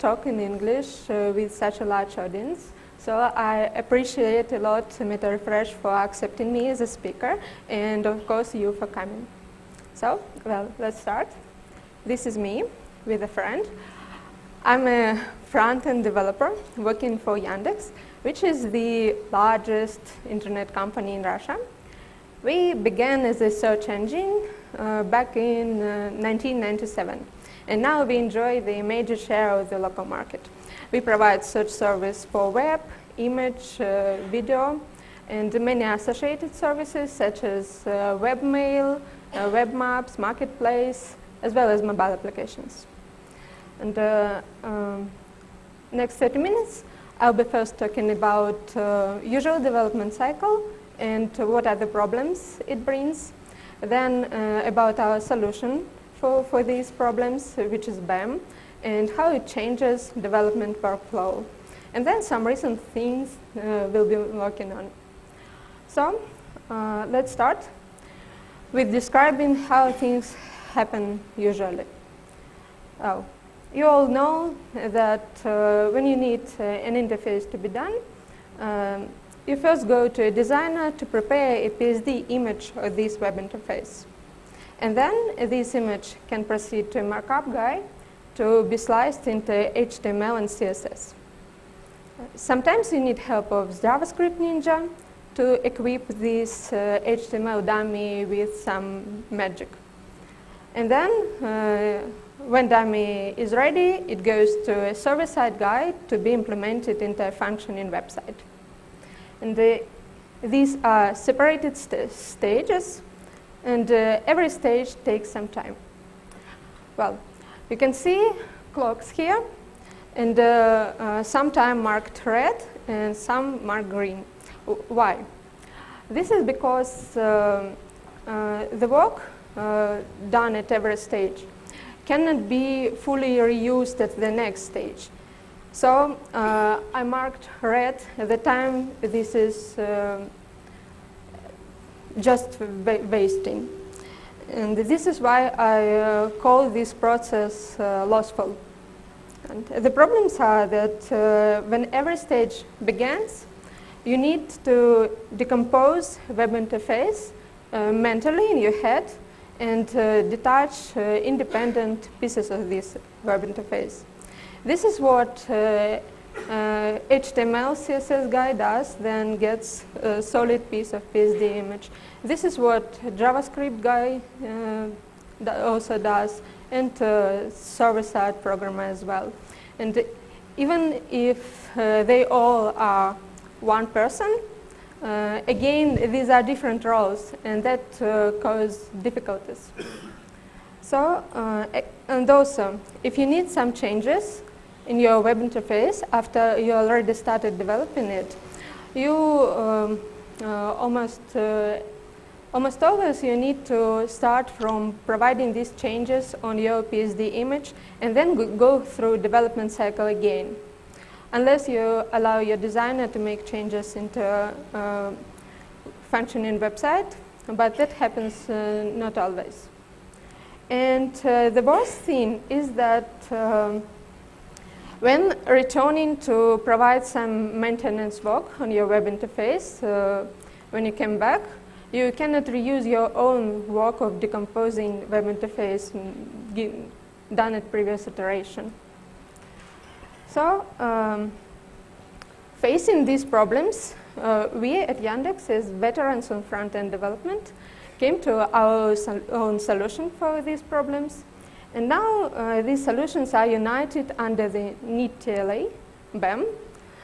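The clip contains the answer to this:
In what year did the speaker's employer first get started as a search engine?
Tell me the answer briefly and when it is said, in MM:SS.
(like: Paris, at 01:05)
1997, at 00:26.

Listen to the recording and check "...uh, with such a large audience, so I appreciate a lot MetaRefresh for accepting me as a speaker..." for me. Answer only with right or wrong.
right.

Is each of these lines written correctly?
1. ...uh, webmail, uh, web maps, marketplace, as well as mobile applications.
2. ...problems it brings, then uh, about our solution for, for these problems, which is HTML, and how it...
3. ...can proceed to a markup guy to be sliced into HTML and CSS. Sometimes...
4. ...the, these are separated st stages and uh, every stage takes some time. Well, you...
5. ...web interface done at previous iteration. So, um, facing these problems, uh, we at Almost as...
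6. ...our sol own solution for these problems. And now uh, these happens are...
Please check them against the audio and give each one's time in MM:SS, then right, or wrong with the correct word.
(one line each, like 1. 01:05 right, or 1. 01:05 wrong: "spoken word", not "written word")
1. 00:37 right
2. 00:51 wrong: "BEM", not "HTML"
3. 01:26 right
4. 01:49 right
5. 03:55 wrong: "Yandex", not "Almost"
6. 04:08 wrong: "solutions", not "happens".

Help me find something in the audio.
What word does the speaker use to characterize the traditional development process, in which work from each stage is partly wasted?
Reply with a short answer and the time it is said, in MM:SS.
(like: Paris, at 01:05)
lossful, at 02:28.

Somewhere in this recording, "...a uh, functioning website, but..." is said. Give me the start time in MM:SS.
03:34.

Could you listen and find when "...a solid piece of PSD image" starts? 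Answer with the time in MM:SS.
02:50.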